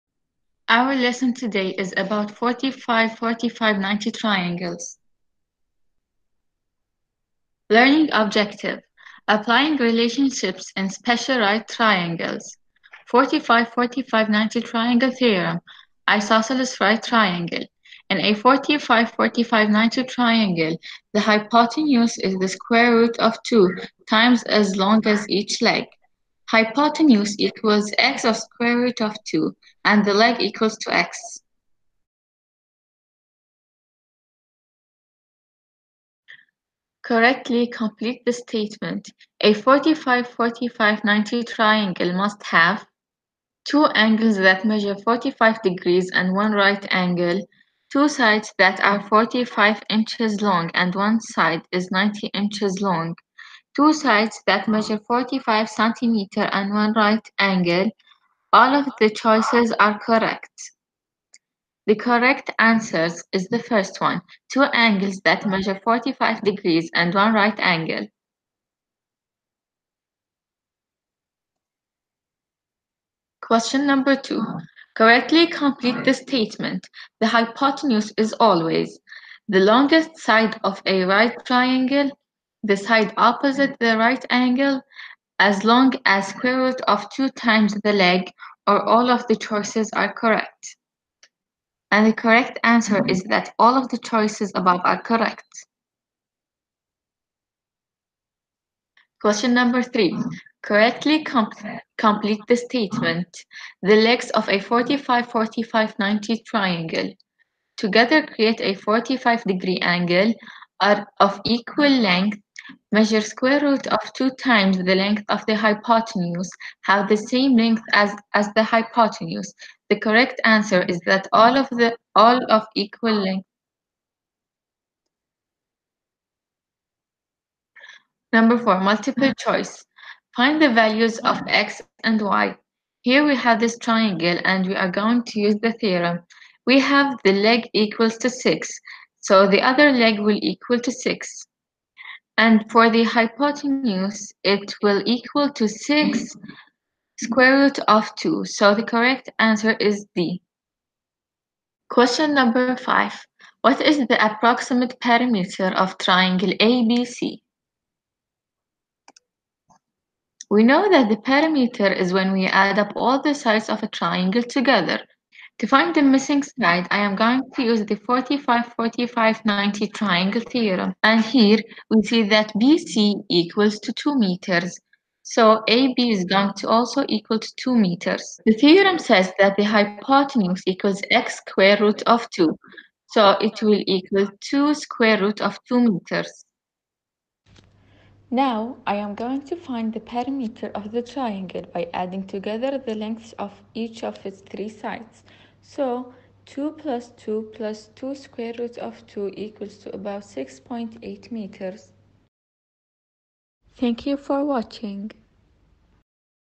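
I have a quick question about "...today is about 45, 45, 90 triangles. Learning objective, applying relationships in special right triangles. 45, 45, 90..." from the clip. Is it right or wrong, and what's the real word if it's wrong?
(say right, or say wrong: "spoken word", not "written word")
right.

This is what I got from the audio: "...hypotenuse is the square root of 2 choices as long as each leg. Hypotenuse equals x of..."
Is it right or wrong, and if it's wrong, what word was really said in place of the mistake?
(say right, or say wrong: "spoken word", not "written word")
wrong: "times", not "choices".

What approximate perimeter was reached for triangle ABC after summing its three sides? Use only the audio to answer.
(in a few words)
6.8 meters.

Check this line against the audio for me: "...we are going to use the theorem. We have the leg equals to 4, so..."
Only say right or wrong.
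wrong.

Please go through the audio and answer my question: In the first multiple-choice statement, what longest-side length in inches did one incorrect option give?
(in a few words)
90 inches.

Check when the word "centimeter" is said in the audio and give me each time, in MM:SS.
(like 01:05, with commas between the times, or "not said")
00:55.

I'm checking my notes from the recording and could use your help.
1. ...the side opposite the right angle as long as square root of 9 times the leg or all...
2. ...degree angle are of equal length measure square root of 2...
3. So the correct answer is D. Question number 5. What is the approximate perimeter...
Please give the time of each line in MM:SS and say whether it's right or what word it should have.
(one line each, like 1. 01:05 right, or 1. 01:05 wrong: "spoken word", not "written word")
1. 01:22 wrong: "2", not "9"
2. 01:49 right
3. 02:28 right.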